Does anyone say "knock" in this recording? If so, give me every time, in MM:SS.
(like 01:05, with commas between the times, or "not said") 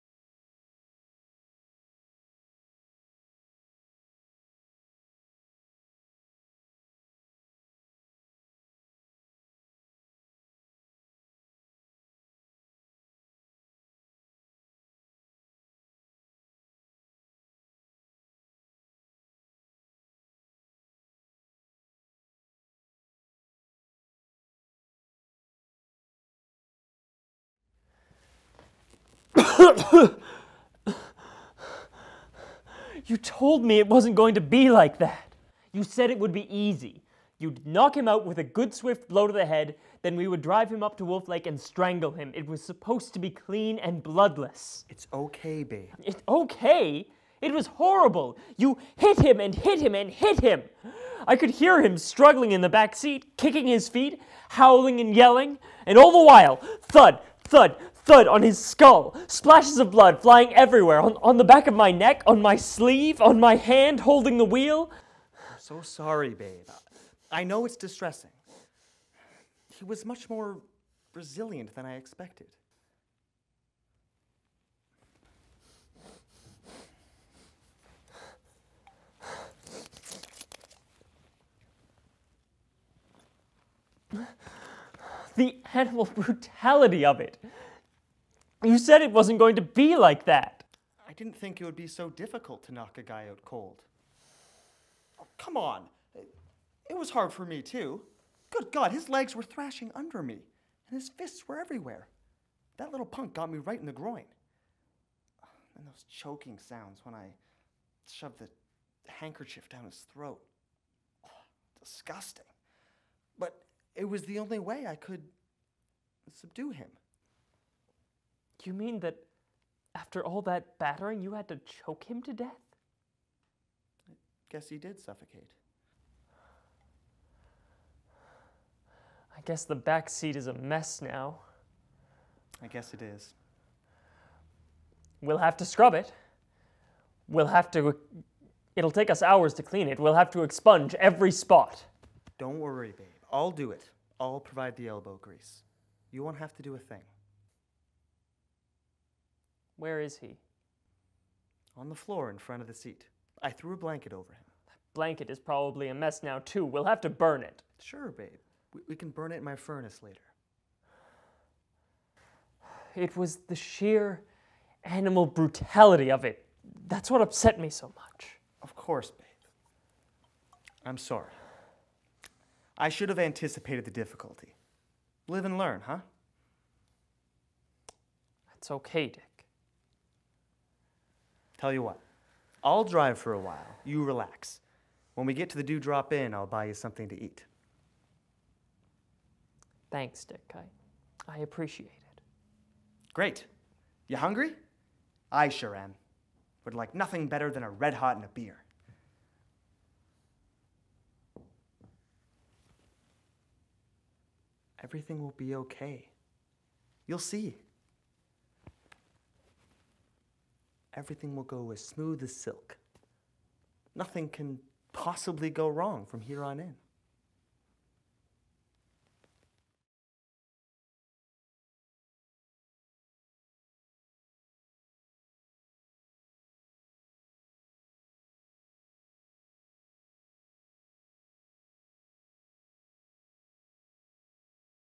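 00:37, 01:32.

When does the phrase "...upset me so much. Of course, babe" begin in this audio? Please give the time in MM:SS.
02:47.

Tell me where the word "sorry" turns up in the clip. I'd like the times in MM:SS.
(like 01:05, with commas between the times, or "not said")
01:05, 02:50.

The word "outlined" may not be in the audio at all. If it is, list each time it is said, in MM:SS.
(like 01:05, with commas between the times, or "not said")
not said.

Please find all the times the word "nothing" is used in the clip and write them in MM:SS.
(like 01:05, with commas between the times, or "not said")
03:16, 03:33.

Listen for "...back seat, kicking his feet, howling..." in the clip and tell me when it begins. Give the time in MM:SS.
00:52.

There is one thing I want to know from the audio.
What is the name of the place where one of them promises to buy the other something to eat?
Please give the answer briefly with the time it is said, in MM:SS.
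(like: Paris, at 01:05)
Dew Drop Inn, at 03:05.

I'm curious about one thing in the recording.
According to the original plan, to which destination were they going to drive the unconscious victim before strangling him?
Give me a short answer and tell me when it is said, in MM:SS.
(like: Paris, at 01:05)
Wolf Lake, at 00:41.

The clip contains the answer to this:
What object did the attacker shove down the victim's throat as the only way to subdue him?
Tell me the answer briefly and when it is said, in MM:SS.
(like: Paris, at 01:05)
handkerchief, at 01:49.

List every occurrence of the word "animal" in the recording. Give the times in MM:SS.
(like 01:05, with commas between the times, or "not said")
01:25, 02:44.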